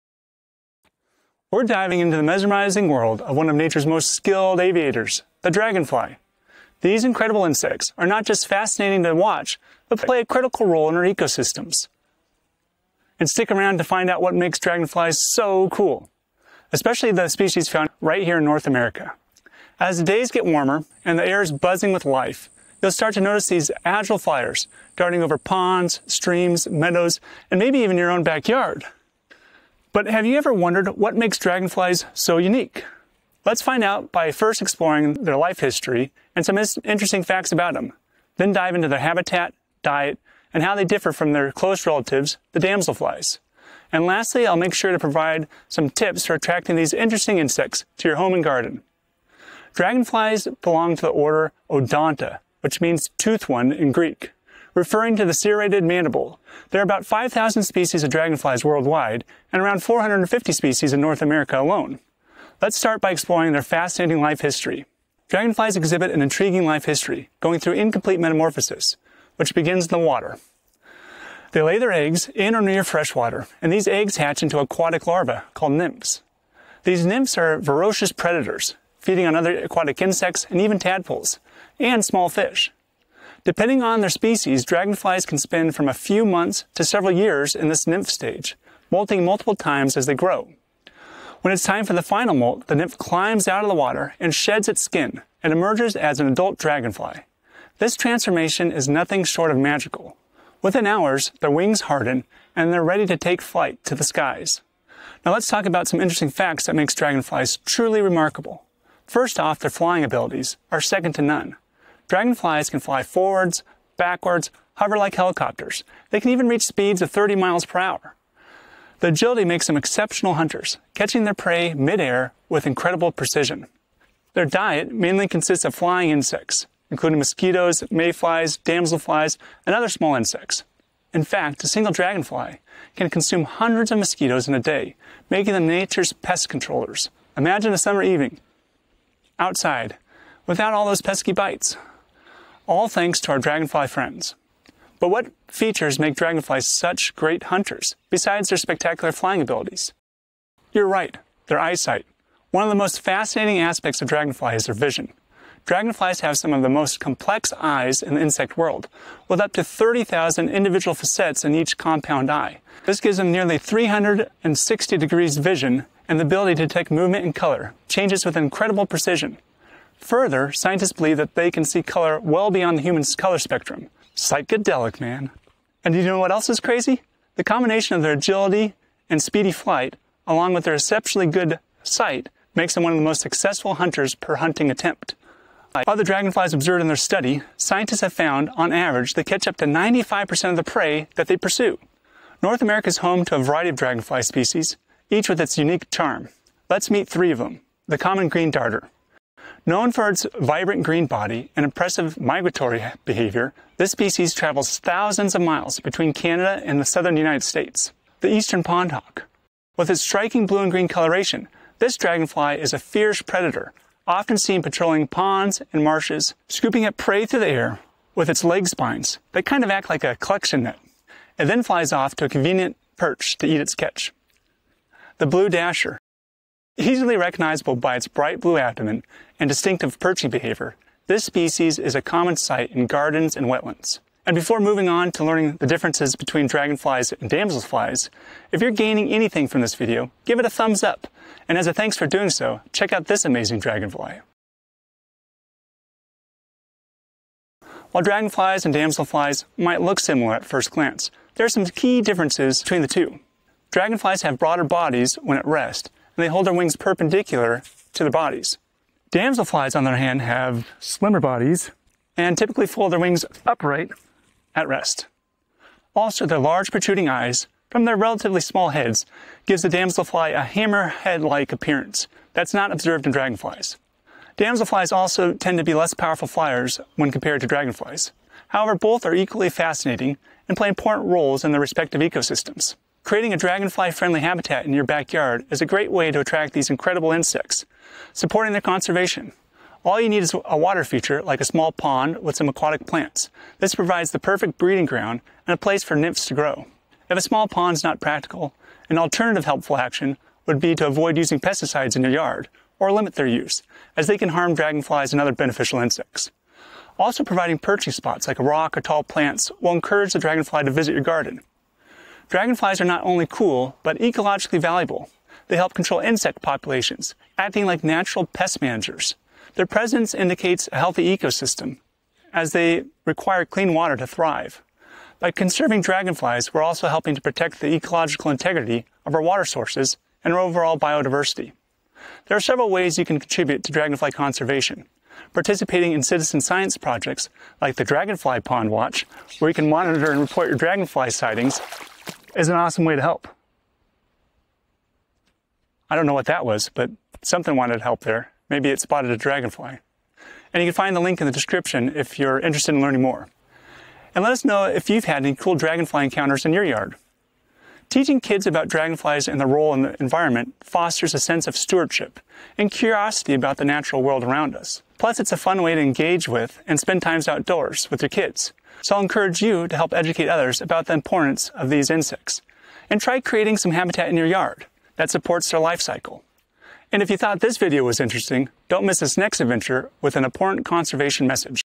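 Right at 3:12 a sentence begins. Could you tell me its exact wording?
North America is home to a variety of dragonfly species, each with its unique charm.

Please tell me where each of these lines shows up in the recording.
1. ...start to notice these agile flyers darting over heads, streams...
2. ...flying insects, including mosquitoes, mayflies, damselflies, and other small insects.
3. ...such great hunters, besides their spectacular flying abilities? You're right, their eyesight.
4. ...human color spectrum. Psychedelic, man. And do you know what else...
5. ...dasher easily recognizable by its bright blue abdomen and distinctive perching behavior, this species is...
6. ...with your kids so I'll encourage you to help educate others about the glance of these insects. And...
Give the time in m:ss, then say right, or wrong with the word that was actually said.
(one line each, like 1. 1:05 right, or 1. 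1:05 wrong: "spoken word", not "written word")
1. 0:22 wrong: "ponds", not "heads"
2. 2:05 right
3. 2:26 right
4. 2:52 right
5. 3:45 right
6. 6:07 wrong: "importance", not "glance".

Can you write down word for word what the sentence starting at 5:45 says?
I don't know what that was, but something wanted help there.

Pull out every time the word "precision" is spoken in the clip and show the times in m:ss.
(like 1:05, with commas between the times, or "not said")
2:03, 2:48.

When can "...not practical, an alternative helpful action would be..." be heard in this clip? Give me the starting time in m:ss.
4:57.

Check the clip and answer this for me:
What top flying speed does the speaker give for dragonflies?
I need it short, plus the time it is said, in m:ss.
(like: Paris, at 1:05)
30 miles per hour, at 1:57.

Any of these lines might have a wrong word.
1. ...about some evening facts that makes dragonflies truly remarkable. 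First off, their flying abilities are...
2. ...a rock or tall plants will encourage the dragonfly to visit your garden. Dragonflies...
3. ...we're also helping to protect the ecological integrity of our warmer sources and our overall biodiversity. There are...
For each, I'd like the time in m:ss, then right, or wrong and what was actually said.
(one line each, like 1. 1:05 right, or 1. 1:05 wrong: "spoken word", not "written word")
1. 1:45 wrong: "interesting", not "evening"
2. 5:08 right
3. 5:26 wrong: "water", not "warmer".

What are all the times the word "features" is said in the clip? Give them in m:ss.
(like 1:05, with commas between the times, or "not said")
2:25, 4:50.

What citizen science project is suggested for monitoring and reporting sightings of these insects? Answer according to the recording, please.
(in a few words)
Dragonfly Pond Watch.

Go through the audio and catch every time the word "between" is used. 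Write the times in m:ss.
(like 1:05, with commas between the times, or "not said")
3:25, 3:56, 4:12.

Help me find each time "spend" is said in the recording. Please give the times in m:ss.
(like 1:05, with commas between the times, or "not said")
1:25, 6:06.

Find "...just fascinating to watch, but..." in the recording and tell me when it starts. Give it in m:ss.
0:08.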